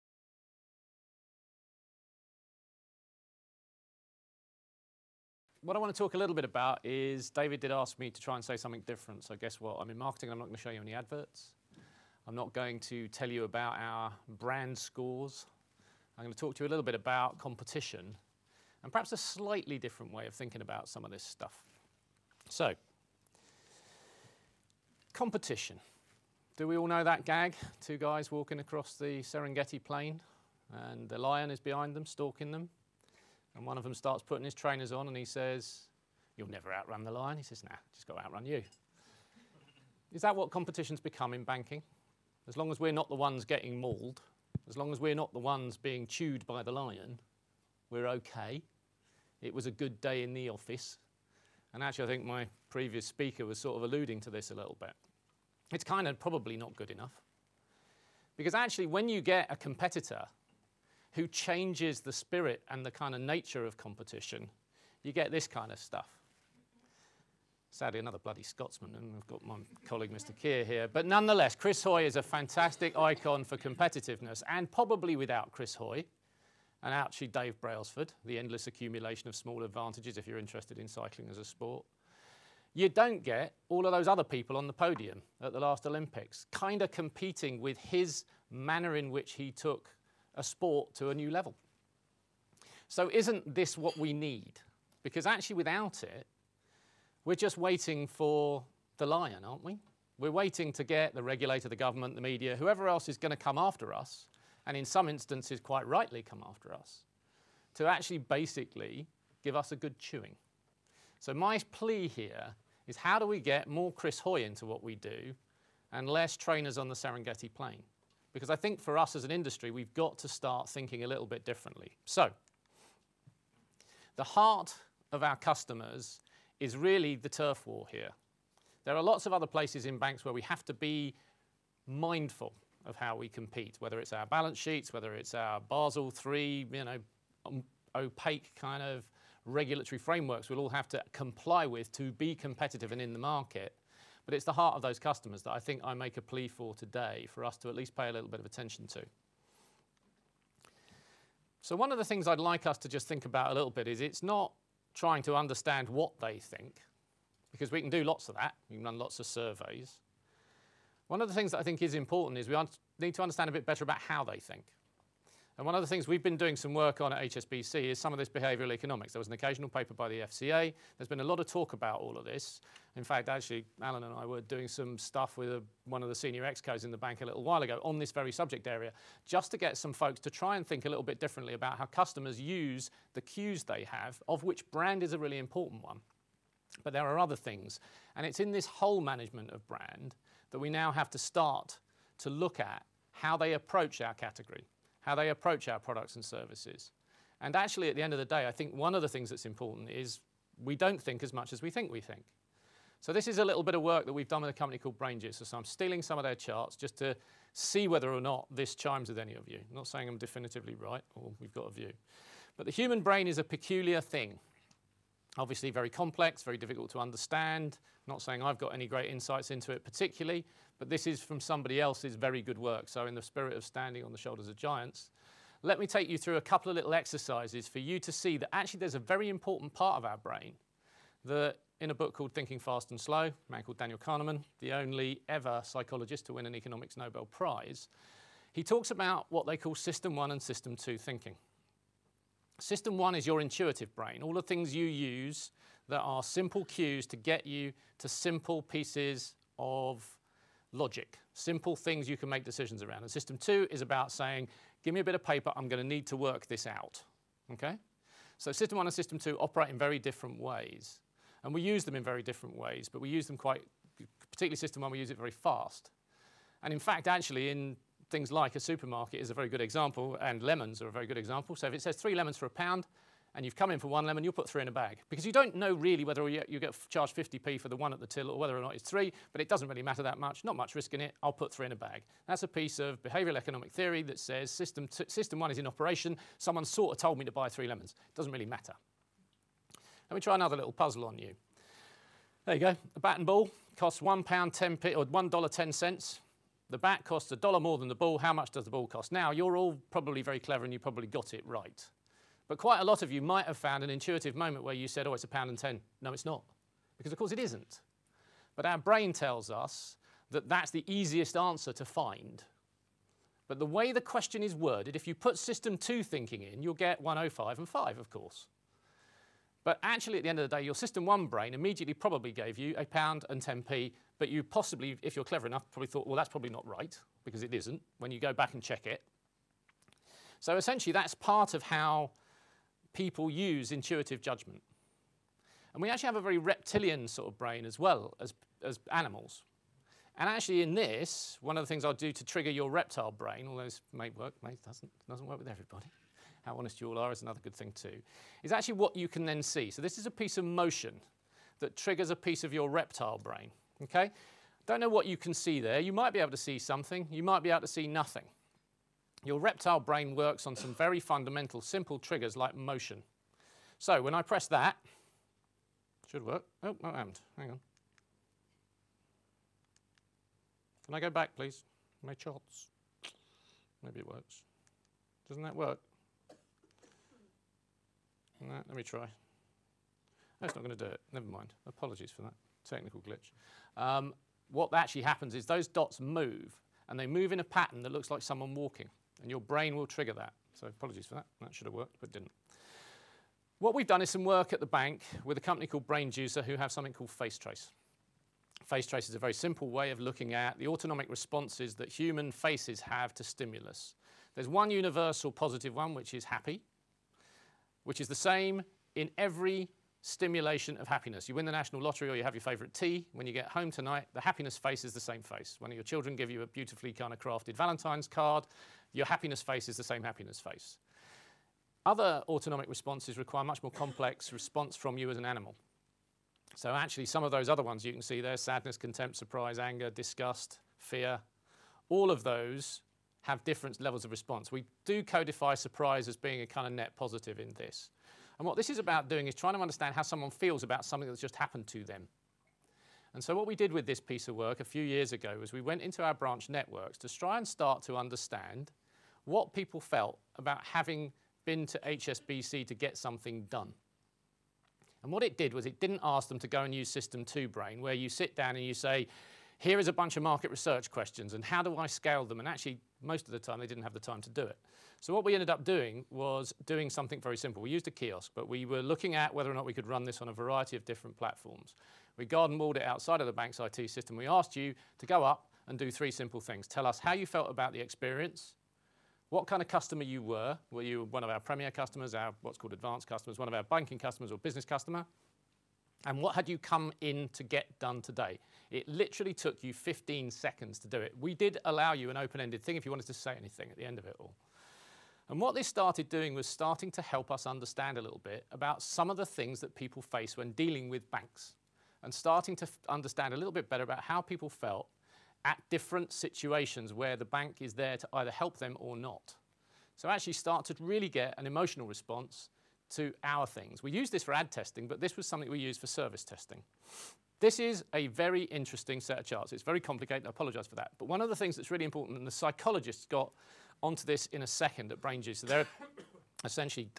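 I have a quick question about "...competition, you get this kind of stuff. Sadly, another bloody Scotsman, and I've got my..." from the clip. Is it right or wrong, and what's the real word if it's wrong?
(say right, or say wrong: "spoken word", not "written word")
right.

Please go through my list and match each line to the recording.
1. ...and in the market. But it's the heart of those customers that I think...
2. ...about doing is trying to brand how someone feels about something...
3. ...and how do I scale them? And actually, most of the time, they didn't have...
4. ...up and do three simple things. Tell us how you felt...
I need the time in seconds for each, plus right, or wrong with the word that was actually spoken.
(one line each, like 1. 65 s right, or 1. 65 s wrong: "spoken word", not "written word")
1. 142 s right
2. 438 s wrong: "understand", not "brand"
3. 461 s right
4. 475 s right.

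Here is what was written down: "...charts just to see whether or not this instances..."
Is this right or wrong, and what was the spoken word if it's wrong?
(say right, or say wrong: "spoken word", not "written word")
wrong: "chimes", not "instances".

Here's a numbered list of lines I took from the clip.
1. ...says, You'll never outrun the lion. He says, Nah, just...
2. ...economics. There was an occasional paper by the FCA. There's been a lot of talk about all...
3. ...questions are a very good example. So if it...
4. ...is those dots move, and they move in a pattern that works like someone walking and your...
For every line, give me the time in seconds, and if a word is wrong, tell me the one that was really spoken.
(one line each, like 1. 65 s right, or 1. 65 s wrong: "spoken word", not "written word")
1. 35 s right
2. 168 s right
3. 270 s wrong: "lemons", not "questions"
4. 385 s wrong: "looks", not "works".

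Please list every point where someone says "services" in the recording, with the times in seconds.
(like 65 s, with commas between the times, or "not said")
196 s, 515 s.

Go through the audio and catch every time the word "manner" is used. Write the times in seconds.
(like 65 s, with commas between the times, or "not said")
88 s.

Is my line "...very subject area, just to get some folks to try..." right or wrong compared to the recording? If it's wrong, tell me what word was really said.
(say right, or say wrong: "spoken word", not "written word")
right.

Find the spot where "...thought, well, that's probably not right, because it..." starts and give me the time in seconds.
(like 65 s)
325 s.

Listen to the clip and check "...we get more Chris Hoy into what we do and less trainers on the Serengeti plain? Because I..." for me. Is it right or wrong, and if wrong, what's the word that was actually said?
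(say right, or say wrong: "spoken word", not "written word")
right.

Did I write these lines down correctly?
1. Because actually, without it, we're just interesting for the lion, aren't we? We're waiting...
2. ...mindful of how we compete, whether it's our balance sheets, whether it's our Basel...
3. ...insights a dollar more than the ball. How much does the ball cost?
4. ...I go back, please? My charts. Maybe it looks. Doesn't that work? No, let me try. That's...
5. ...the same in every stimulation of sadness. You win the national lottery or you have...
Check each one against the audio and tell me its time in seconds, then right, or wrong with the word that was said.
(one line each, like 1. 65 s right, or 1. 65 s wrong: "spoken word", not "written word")
1. 95 s wrong: "waiting", not "interesting"
2. 131 s right
3. 297 s wrong: "costs", not "insights"
4. 370 s wrong: "works", not "looks"
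5. 408 s wrong: "happiness", not "sadness".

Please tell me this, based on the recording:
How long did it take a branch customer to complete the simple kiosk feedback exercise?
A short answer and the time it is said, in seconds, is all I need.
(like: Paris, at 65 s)
15 seconds, at 489 s.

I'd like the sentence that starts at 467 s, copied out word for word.
We used a kiosk, but we were looking at whether or not we could run this on a variety of different platforms.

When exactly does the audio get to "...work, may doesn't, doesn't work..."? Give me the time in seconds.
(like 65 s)
344 s.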